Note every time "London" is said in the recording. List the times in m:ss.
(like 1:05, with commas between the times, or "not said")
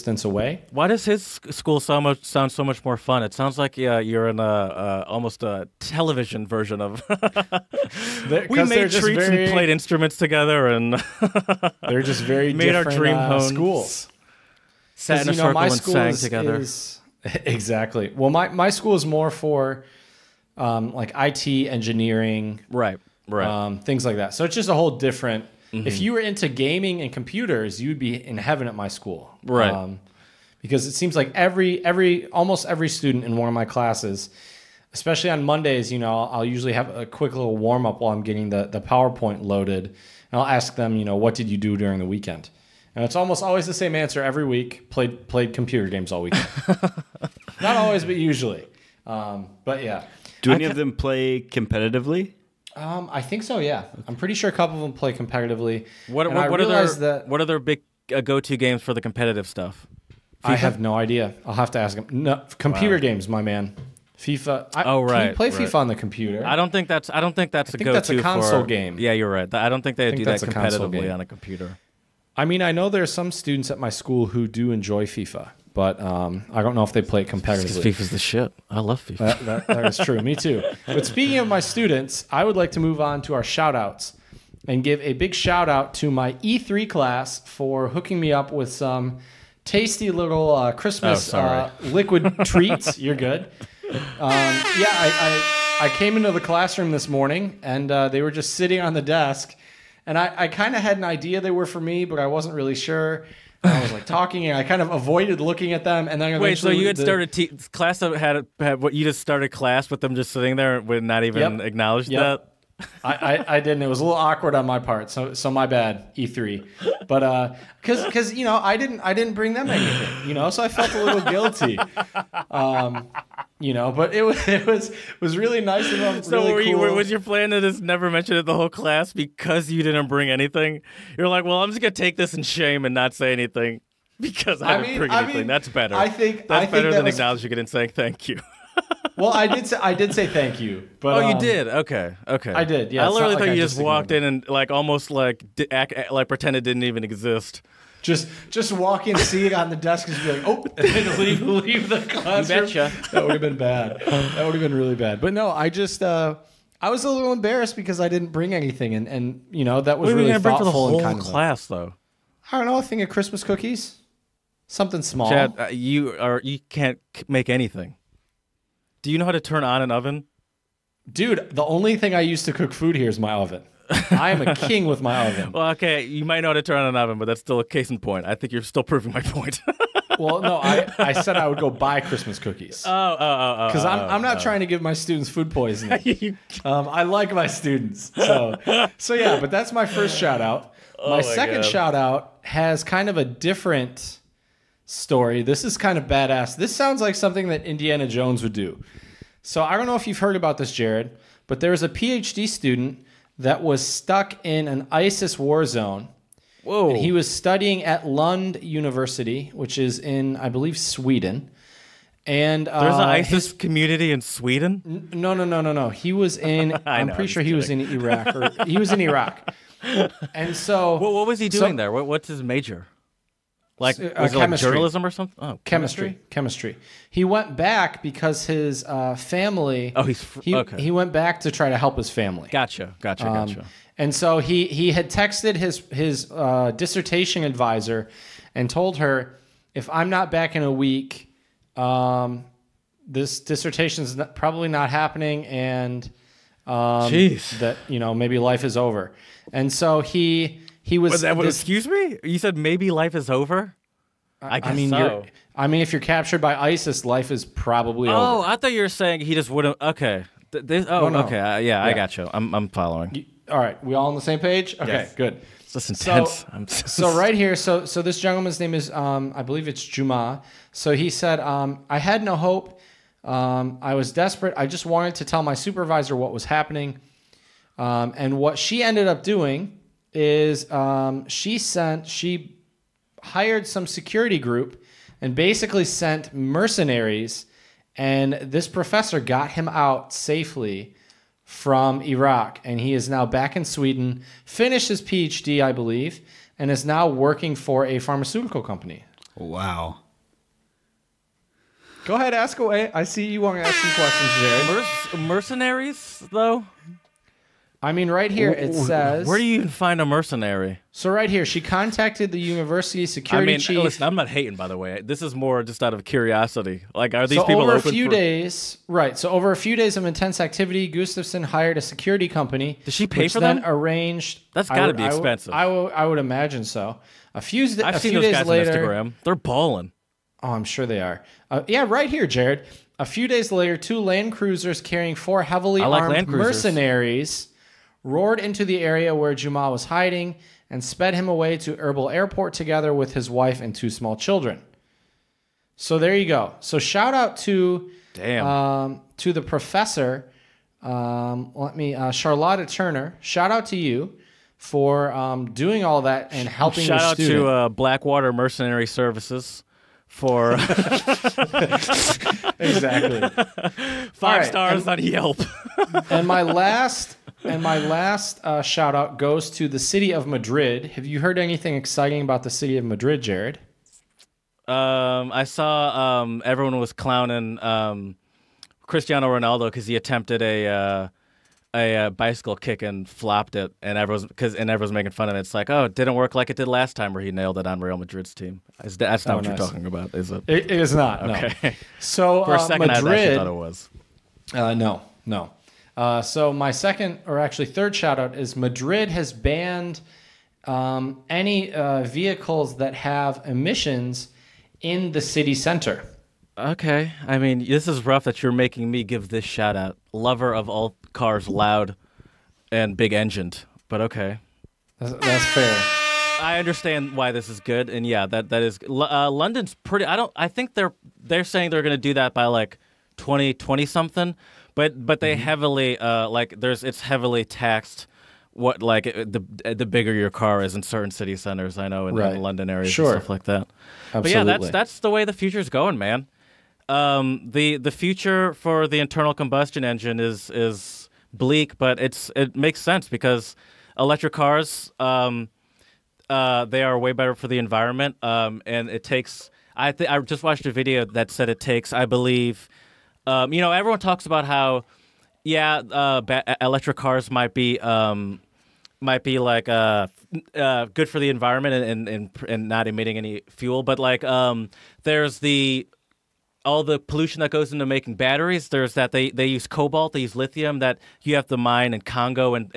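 6:59, 7:12.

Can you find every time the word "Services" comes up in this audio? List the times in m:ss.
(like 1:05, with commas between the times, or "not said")
5:58.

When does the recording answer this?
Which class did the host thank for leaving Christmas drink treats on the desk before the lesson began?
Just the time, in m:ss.
1:26.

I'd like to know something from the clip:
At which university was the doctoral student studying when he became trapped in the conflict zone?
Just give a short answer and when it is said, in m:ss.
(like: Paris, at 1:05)
Lund University, at 3:28.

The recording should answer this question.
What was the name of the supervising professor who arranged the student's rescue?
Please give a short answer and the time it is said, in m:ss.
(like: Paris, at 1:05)
Charlotta Turner, at 5:52.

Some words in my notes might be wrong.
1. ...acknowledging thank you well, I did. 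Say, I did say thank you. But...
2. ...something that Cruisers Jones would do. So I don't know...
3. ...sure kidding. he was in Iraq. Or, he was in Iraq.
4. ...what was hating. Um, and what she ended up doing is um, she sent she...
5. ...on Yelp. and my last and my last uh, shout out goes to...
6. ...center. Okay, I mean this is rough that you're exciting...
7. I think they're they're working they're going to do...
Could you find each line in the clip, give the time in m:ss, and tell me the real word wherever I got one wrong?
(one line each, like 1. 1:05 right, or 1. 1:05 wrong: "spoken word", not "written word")
1. 2:17 wrong: "saying", not "acknowledging"
2. 3:17 wrong: "Indiana", not "Cruisers"
3. 3:37 right
4. 4:36 wrong: "happening", not "hating"
5. 6:05 right
6. 6:45 wrong: "making", not "exciting"
7. 7:00 wrong: "saying", not "working".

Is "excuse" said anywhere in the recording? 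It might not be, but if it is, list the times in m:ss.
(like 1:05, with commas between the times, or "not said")
4:11.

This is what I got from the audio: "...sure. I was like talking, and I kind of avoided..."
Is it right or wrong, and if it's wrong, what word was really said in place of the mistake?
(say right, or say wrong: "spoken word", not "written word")
right.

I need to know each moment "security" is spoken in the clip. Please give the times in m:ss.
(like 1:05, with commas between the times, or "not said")
4:43, 5:13, 5:21.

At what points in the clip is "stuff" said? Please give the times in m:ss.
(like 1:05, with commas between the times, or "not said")
0:59, 7:13.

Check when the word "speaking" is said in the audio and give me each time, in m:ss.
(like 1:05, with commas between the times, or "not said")
1:21.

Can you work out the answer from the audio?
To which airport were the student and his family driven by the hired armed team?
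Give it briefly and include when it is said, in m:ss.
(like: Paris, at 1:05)
Erbil Airport, at 5:41.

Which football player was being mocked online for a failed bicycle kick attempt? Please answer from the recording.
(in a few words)
Cristiano Ronaldo.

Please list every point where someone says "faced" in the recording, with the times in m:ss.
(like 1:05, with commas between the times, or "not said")
not said.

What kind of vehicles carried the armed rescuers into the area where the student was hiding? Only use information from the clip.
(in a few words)
Land Cruisers.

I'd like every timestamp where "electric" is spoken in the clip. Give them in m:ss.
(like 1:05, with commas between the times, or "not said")
7:23, 7:36.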